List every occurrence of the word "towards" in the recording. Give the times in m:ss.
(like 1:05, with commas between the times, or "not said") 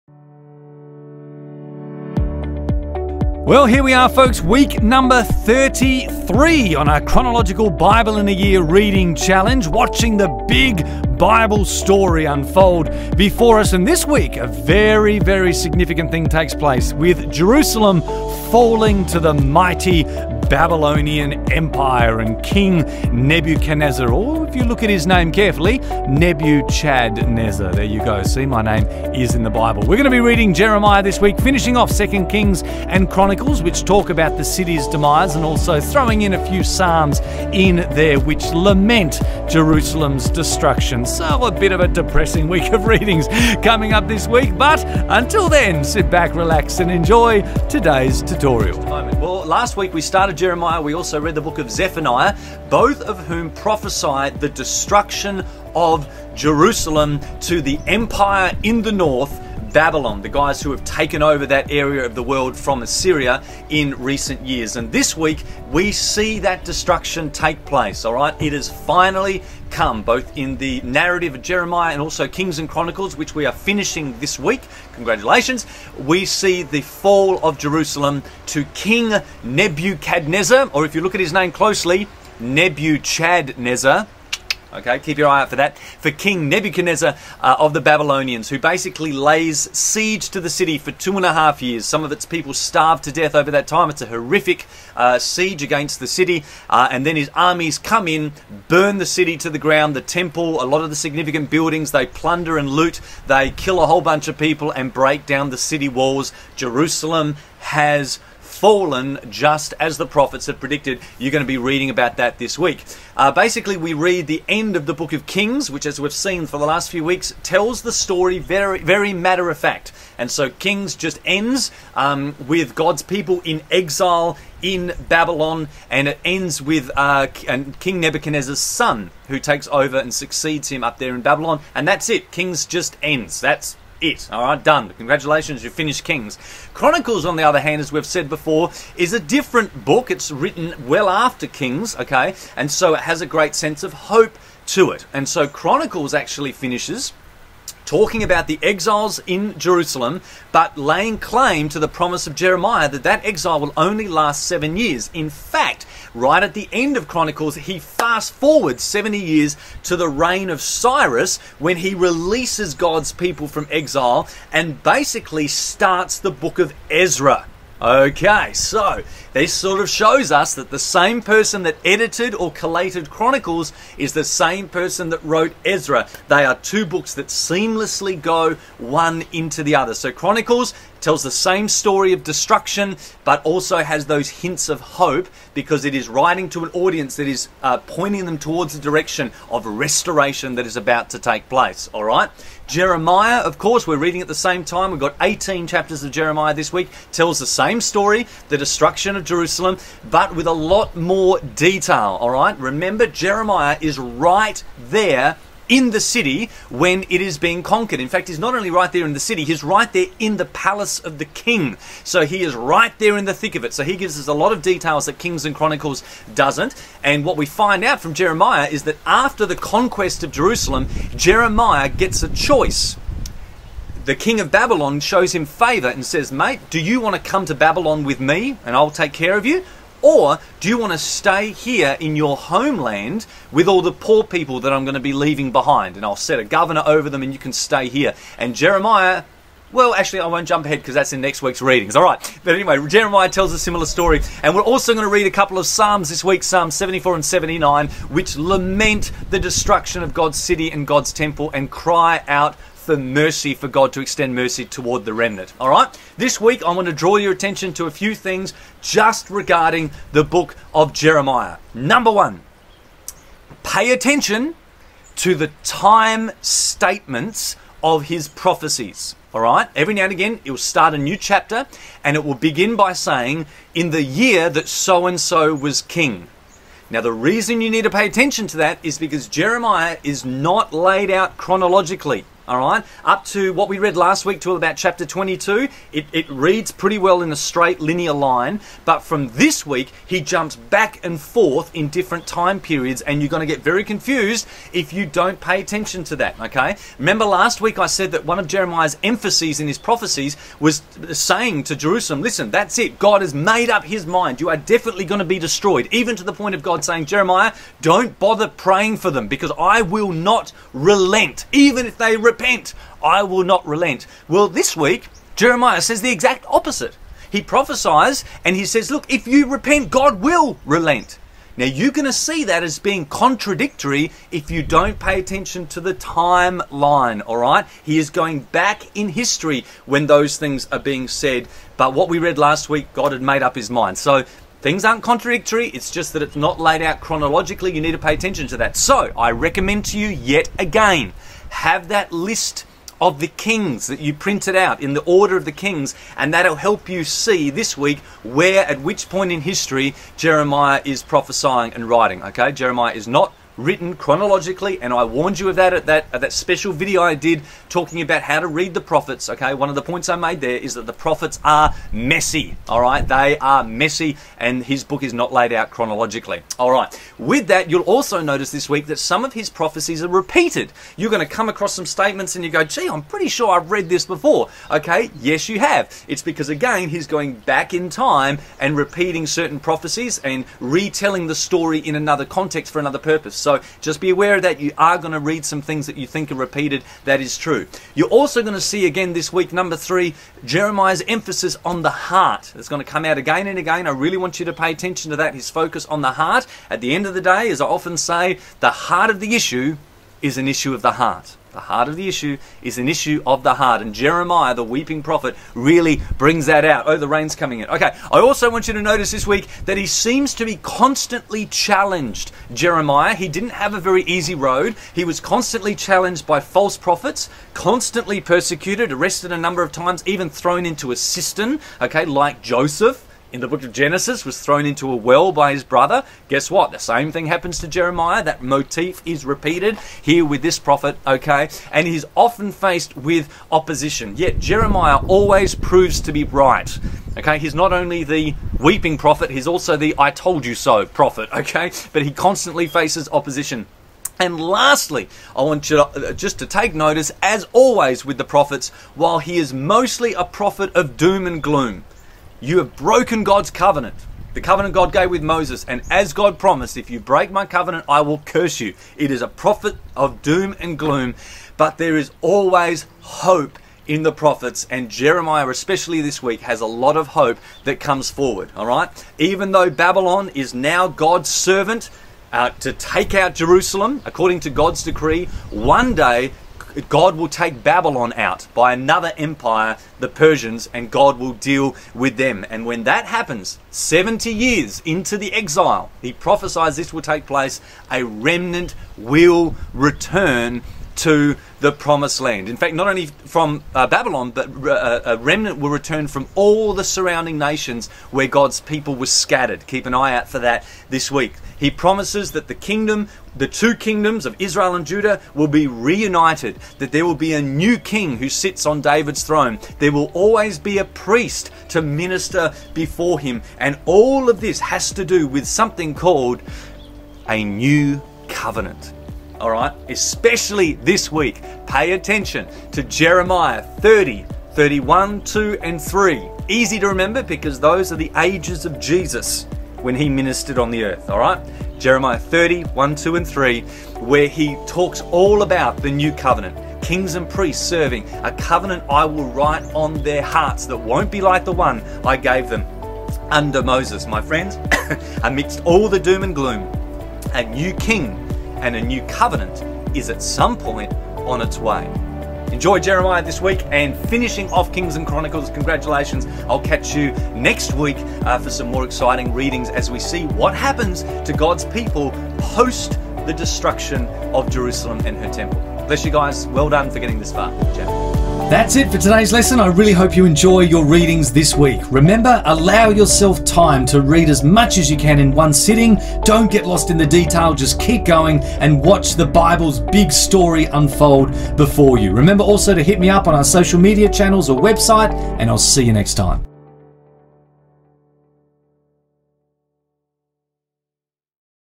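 3:08, 4:14.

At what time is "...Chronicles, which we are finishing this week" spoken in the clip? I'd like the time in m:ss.
1:12.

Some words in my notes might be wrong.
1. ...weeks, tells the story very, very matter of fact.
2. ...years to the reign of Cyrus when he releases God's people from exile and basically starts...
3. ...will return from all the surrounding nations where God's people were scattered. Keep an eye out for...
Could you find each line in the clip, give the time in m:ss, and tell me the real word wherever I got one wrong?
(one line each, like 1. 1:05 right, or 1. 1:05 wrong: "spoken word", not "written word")
1. 1:57 right
2. 2:39 right
3. 8:15 right.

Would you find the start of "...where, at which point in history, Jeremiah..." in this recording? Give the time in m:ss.
5:48.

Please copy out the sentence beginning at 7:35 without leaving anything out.
And as God promised, if you break my covenant, I will curse you.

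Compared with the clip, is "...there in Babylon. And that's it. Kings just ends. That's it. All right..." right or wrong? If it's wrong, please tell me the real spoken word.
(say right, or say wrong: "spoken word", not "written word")
right.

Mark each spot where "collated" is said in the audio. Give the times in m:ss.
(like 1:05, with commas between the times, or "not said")
2:52.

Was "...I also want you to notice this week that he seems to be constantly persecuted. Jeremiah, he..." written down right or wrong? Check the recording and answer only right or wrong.
wrong.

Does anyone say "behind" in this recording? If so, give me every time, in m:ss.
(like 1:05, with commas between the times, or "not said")
3:55.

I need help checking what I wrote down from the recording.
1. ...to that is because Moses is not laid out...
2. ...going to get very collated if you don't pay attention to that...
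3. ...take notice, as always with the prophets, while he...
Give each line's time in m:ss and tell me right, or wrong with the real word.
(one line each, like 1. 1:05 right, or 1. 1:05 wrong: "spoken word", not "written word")
1. 4:38 wrong: "Jeremiah", not "Moses"
2. 4:53 wrong: "confused", not "collated"
3. 7:26 right.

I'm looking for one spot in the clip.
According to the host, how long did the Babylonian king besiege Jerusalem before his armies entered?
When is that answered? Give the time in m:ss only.
1:30.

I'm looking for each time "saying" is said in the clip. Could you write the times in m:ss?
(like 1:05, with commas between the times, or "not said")
4:32, 5:01, 5:06.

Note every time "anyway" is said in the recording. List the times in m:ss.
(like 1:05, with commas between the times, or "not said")
4:02.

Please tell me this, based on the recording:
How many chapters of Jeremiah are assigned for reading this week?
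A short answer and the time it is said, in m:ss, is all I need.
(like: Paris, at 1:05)
18, at 3:15.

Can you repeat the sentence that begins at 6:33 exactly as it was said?
I really want you to pay attention to that.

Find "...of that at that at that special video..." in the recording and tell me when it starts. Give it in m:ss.
5:55.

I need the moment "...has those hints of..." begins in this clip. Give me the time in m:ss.
3:03.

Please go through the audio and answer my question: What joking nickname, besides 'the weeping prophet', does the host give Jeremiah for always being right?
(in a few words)
The I told you so prophet.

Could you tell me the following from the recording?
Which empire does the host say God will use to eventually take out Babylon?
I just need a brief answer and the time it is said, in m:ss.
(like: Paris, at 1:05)
The Persians, at 7:59.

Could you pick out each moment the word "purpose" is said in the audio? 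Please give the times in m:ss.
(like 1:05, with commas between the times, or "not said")
6:22.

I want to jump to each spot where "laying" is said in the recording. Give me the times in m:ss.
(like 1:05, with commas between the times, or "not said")
2:30.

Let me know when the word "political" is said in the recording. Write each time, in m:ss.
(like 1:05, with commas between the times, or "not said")
not said.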